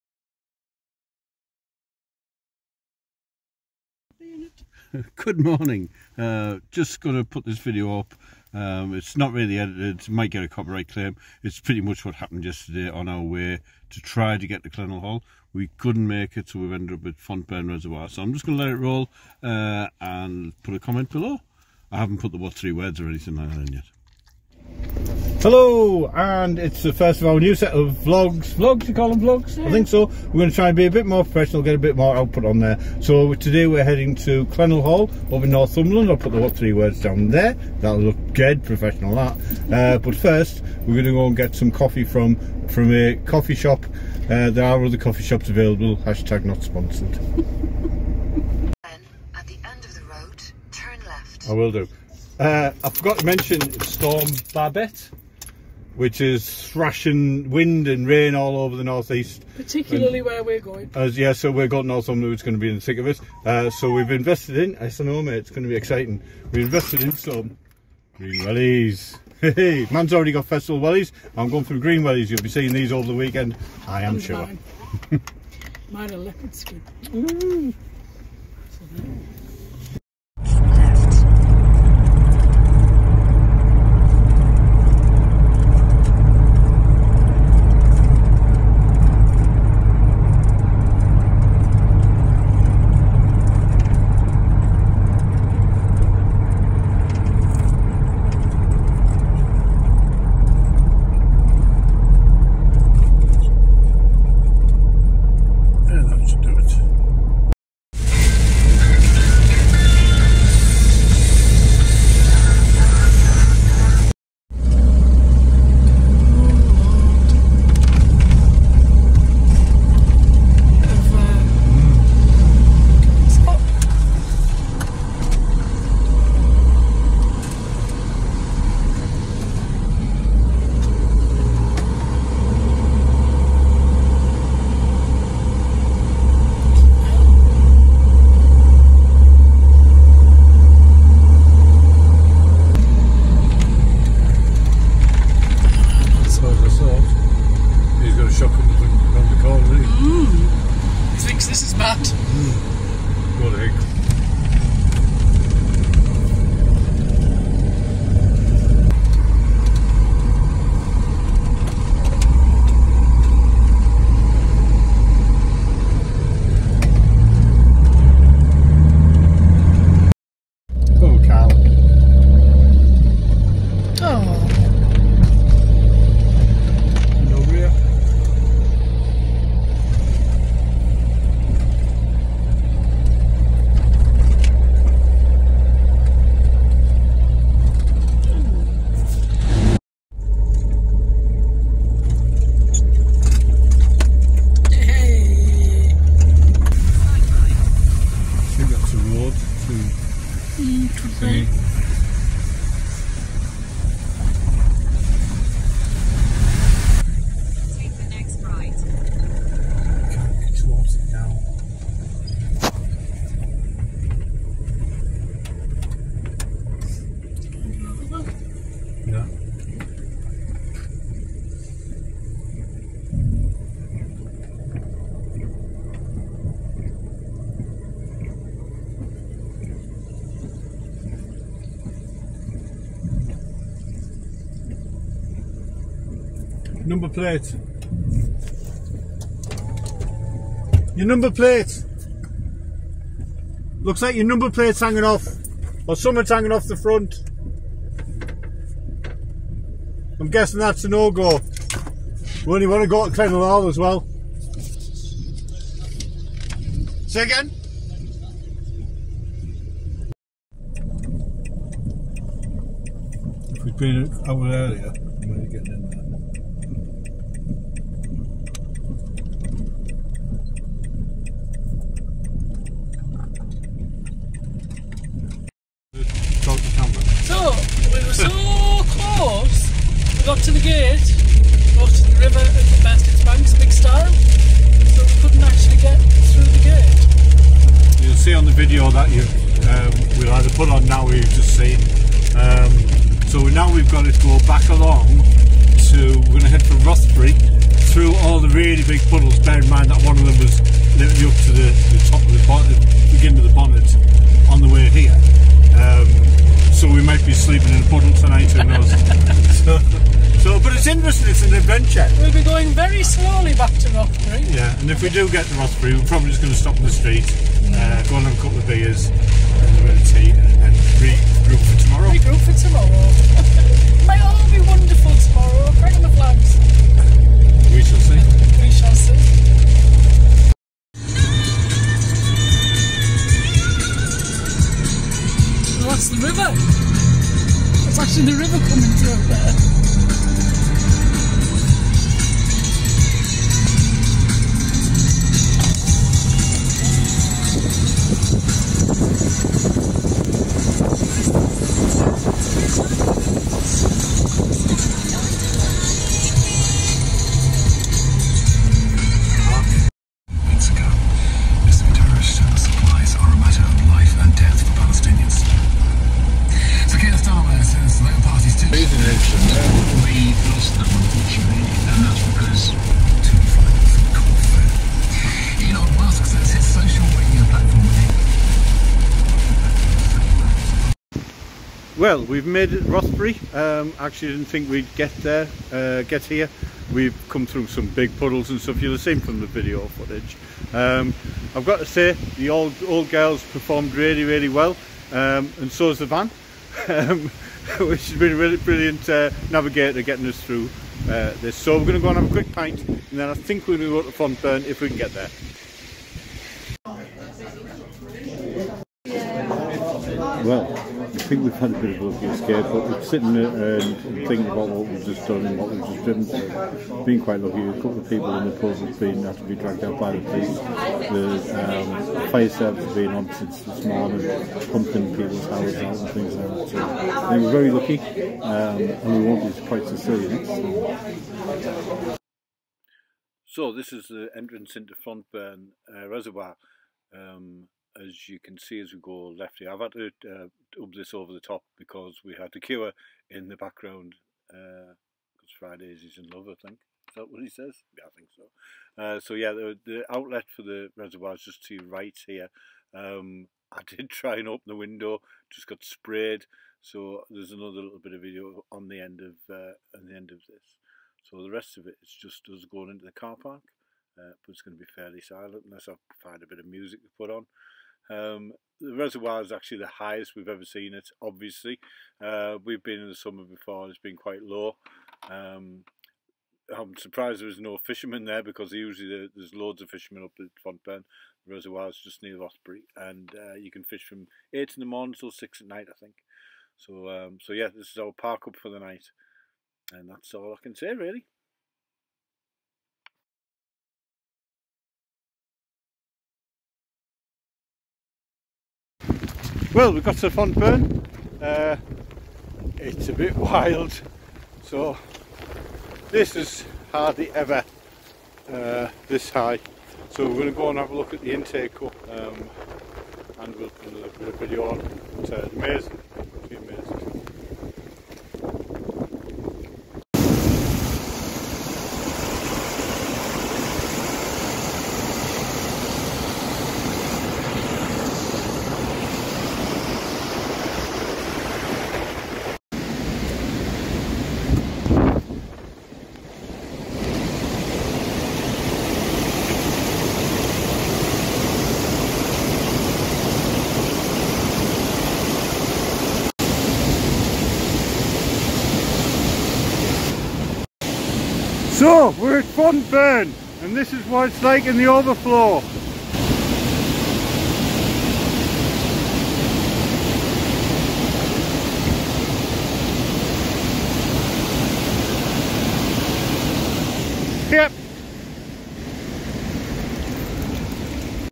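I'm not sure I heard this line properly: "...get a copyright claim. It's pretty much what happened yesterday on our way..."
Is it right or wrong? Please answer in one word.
right.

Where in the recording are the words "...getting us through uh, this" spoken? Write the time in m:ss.
6:40.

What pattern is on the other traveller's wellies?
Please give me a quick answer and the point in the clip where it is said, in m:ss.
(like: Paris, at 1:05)
Leopard skin, at 1:16.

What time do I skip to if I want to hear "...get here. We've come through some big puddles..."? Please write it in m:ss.
6:26.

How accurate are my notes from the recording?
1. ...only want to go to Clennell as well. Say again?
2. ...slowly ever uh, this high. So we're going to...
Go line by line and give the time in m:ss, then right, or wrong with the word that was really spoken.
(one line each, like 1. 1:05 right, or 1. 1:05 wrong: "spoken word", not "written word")
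1. 4:12 right
2. 8:26 wrong: "hardly", not "slowly".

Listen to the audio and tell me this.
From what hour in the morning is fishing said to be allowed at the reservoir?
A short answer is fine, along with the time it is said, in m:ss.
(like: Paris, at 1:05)
8, at 8:04.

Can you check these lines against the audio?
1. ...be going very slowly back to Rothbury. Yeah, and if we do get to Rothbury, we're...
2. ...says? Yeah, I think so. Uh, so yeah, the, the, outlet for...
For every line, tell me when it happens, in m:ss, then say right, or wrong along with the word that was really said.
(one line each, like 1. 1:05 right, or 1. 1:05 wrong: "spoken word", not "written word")
1. 5:12 right
2. 7:27 right.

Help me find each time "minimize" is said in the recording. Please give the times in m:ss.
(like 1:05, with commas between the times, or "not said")
not said.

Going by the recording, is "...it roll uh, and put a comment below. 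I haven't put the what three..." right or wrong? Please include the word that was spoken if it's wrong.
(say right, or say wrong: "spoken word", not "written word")
right.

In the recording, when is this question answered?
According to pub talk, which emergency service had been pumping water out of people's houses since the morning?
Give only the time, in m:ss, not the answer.
7:02.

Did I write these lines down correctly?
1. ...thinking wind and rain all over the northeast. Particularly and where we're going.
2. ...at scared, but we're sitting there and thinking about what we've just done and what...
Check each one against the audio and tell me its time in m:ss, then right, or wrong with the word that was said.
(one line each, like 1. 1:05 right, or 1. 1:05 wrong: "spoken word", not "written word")
1. 0:56 wrong: "thrashing", not "thinking"
2. 6:52 right.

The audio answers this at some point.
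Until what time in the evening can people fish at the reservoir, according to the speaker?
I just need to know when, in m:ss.
8:05.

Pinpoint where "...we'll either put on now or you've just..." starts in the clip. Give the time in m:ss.
4:50.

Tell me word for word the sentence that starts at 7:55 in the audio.
Um, I'm surprised there was no fishermen there because usually there's loads of fishermen up at Fontburn.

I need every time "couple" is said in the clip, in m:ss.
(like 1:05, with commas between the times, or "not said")
5:18, 6:57.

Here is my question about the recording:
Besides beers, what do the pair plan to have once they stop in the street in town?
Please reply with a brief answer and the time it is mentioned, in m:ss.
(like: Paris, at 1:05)
Tea, at 5:19.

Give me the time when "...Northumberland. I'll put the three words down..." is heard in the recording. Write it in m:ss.
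0:35.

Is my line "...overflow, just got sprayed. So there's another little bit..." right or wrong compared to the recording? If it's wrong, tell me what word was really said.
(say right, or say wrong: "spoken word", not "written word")
wrong: "window", not "overflow".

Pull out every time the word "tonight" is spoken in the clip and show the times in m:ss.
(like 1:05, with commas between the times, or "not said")
5:08.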